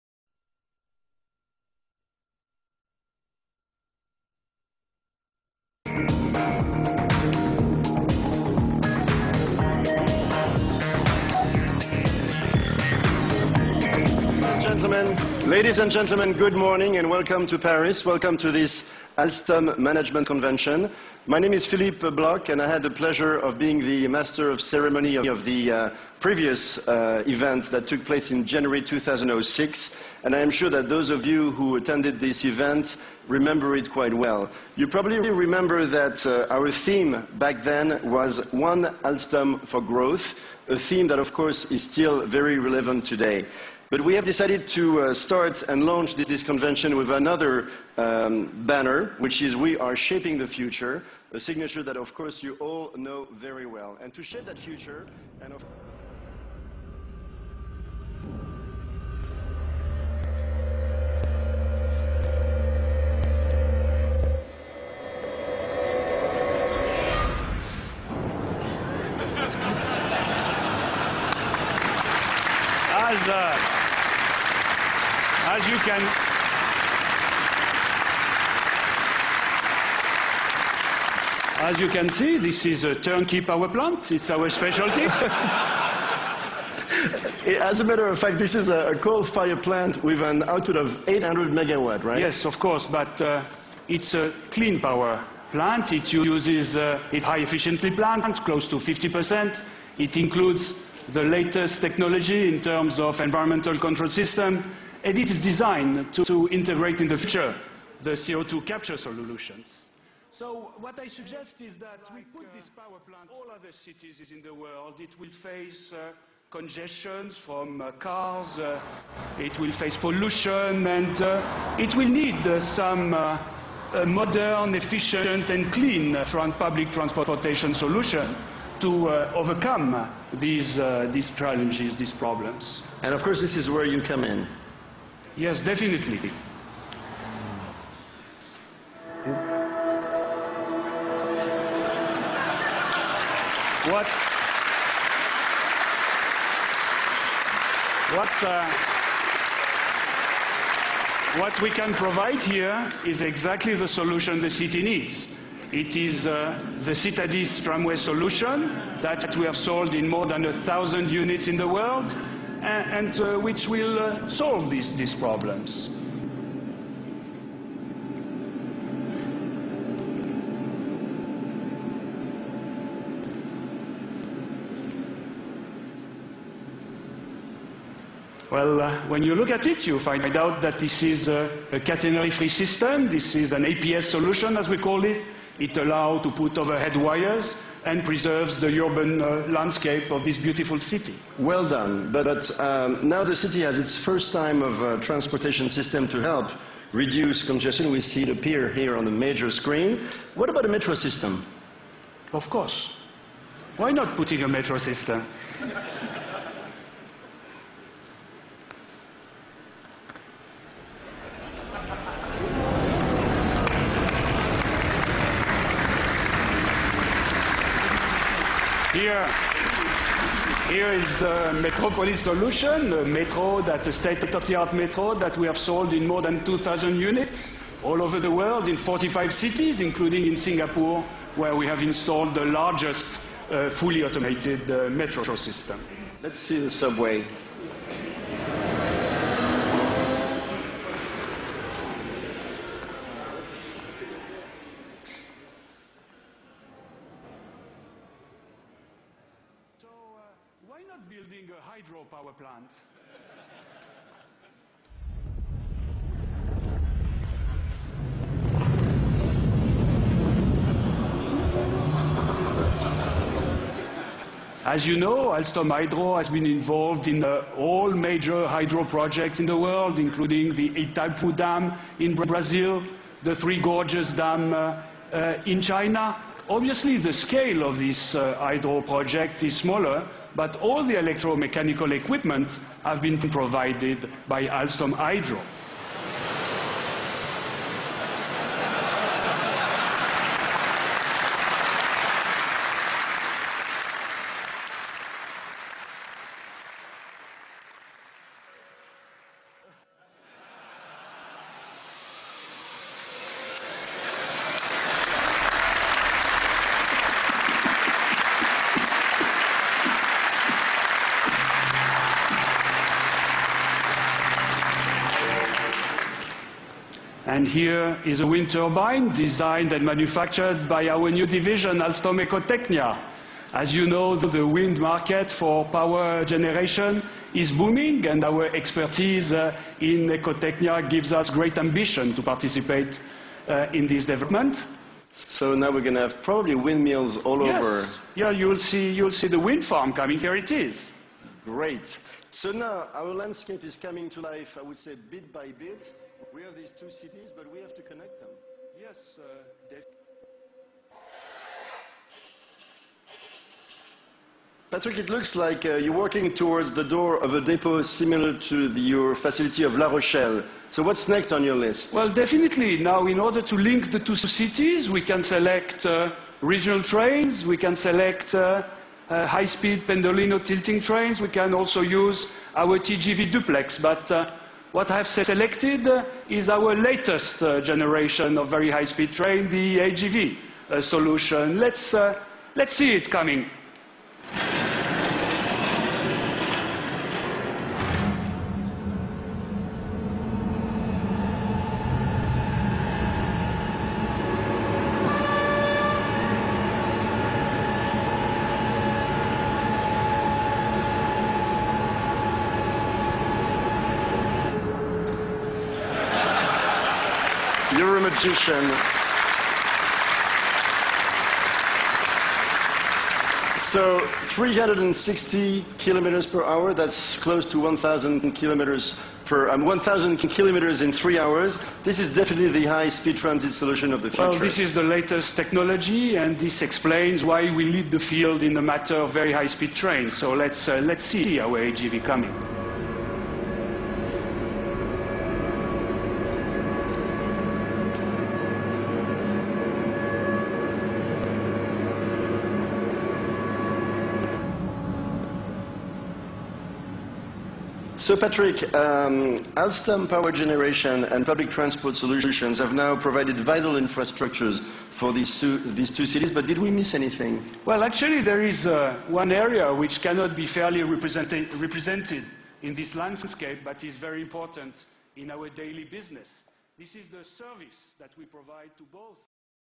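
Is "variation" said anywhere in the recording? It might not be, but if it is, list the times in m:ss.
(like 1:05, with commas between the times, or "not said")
not said.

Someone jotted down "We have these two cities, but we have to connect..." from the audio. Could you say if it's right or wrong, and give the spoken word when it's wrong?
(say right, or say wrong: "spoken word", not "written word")
right.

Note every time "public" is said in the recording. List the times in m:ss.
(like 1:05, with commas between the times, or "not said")
2:06, 7:31.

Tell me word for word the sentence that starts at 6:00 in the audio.
So what's next on your list?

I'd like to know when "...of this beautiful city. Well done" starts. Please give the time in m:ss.
3:10.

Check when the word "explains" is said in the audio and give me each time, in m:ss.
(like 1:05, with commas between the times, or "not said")
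7:06.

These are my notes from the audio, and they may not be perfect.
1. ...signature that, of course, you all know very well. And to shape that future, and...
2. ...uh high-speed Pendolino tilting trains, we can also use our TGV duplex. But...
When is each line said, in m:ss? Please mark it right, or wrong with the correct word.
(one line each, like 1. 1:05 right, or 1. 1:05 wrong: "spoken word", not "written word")
1. 0:51 right
2. 6:09 right.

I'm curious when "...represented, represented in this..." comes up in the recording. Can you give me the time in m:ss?
7:40.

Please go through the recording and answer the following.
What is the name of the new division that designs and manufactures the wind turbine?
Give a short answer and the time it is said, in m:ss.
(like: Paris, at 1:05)
Alstom Ecotechnia, at 5:21.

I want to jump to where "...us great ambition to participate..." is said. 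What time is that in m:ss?
5:31.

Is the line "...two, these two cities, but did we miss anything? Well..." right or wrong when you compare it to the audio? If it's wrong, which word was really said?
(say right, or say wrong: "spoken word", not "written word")
right.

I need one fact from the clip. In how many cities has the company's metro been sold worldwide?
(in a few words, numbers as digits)
45.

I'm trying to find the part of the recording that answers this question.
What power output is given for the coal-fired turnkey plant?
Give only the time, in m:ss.
1:31.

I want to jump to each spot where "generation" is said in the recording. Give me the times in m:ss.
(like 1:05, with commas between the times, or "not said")
5:26, 6:17, 7:30.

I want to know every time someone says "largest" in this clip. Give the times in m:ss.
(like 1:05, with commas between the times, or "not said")
3:52.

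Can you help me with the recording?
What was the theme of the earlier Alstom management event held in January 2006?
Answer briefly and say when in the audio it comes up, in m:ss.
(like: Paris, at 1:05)
One Alstom for Growth, at 0:38.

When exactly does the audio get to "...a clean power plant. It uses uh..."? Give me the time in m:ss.
1:34.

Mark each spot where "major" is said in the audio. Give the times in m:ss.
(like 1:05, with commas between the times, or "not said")
3:19, 4:27.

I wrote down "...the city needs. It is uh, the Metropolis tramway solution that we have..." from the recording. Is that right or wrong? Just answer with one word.
wrong.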